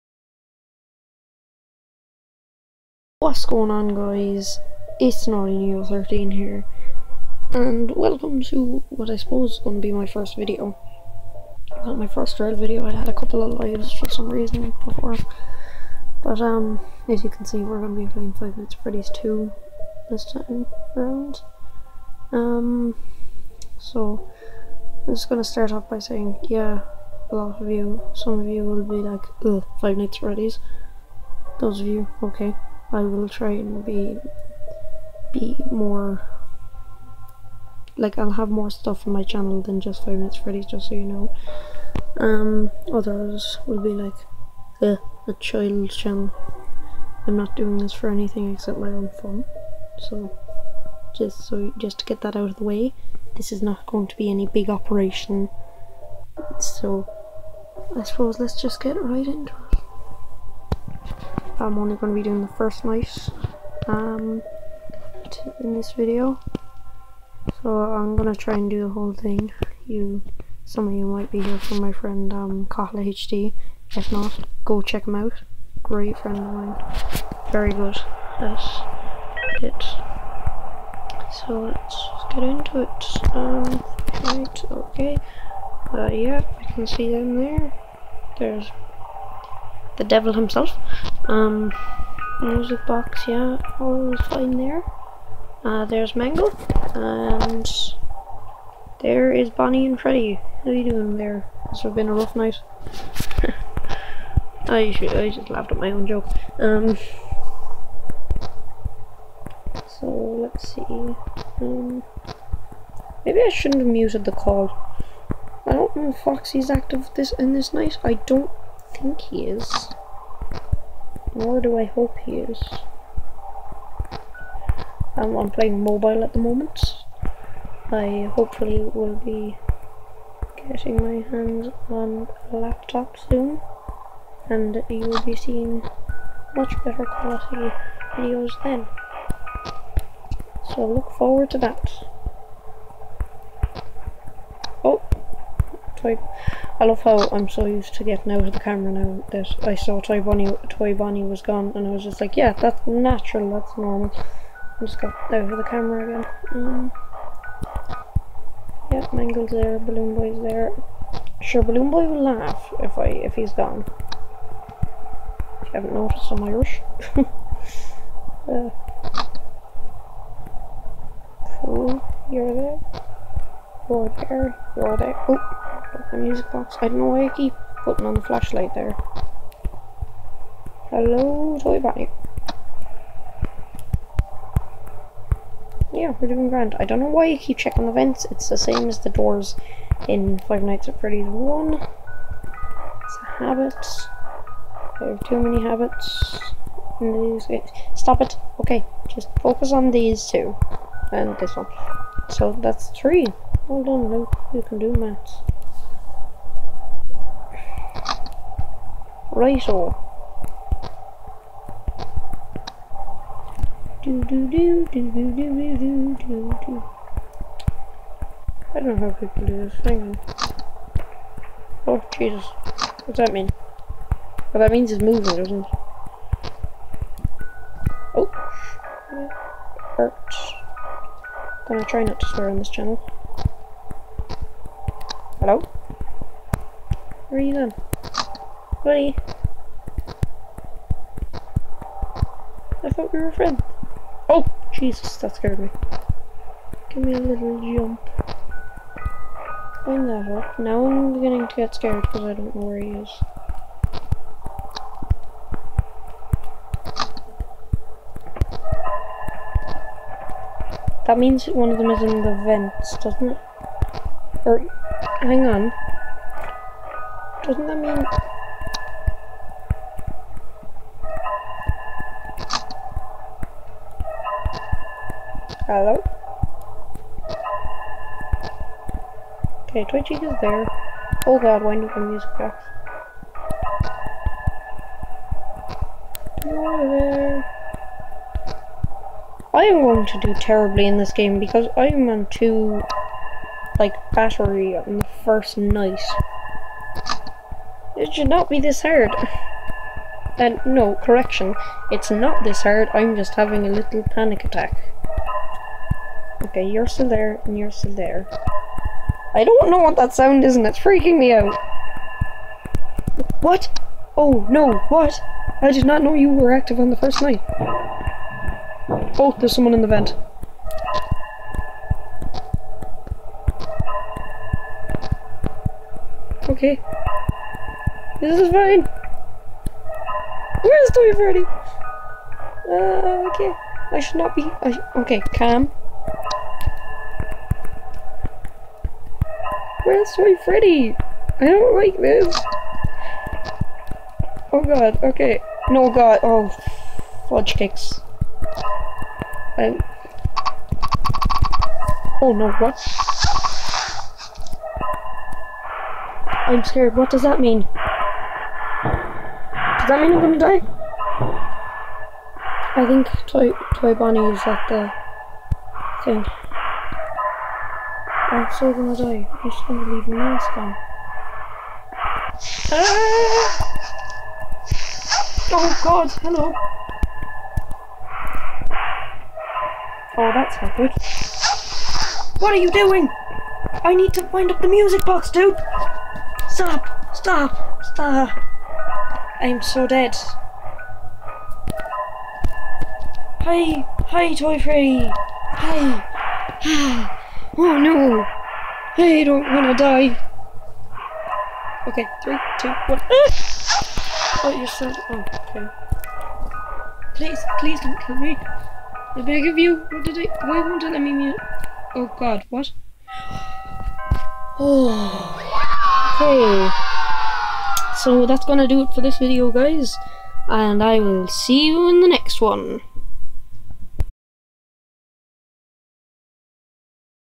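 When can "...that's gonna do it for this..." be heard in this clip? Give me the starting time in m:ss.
6:58.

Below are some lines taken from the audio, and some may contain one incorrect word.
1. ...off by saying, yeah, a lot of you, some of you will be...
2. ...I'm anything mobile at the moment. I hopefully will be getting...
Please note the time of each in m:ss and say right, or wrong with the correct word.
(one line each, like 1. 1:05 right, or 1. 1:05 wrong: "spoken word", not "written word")
1. 0:25 right
2. 2:05 wrong: "playing", not "anything".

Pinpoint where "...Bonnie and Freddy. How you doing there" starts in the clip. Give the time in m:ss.
1:39.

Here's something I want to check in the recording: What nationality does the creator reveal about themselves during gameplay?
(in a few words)
Irish.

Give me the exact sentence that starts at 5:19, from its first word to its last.
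Oh, there's someone in the vent.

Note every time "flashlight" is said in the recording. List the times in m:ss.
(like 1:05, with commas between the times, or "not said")
2:58.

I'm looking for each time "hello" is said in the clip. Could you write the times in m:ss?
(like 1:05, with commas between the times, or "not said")
3:00, 3:55, 4:35, 6:16.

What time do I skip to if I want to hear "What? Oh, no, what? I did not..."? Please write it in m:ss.
5:13.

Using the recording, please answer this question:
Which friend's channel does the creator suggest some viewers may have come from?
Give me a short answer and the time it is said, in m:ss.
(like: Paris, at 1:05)
Kahla HD, at 1:12.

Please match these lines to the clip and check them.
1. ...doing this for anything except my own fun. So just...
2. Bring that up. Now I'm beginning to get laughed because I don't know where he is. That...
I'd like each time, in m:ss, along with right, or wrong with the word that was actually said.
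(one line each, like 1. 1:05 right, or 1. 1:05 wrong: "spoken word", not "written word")
1. 0:47 right
2. 4:09 wrong: "scared", not "laughed".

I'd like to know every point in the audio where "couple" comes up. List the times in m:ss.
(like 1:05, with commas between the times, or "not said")
0:13.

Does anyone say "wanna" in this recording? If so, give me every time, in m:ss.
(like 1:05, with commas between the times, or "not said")
6:39.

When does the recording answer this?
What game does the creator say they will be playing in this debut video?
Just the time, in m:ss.
0:18.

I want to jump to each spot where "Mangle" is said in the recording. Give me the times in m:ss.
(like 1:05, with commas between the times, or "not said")
1:36, 2:39.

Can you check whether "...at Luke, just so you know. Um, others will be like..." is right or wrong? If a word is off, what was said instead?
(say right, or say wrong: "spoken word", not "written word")
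wrong: "Freddy", not "Luke".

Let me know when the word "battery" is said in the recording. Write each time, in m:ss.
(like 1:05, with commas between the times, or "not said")
4:54.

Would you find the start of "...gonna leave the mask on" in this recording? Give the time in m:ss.
6:09.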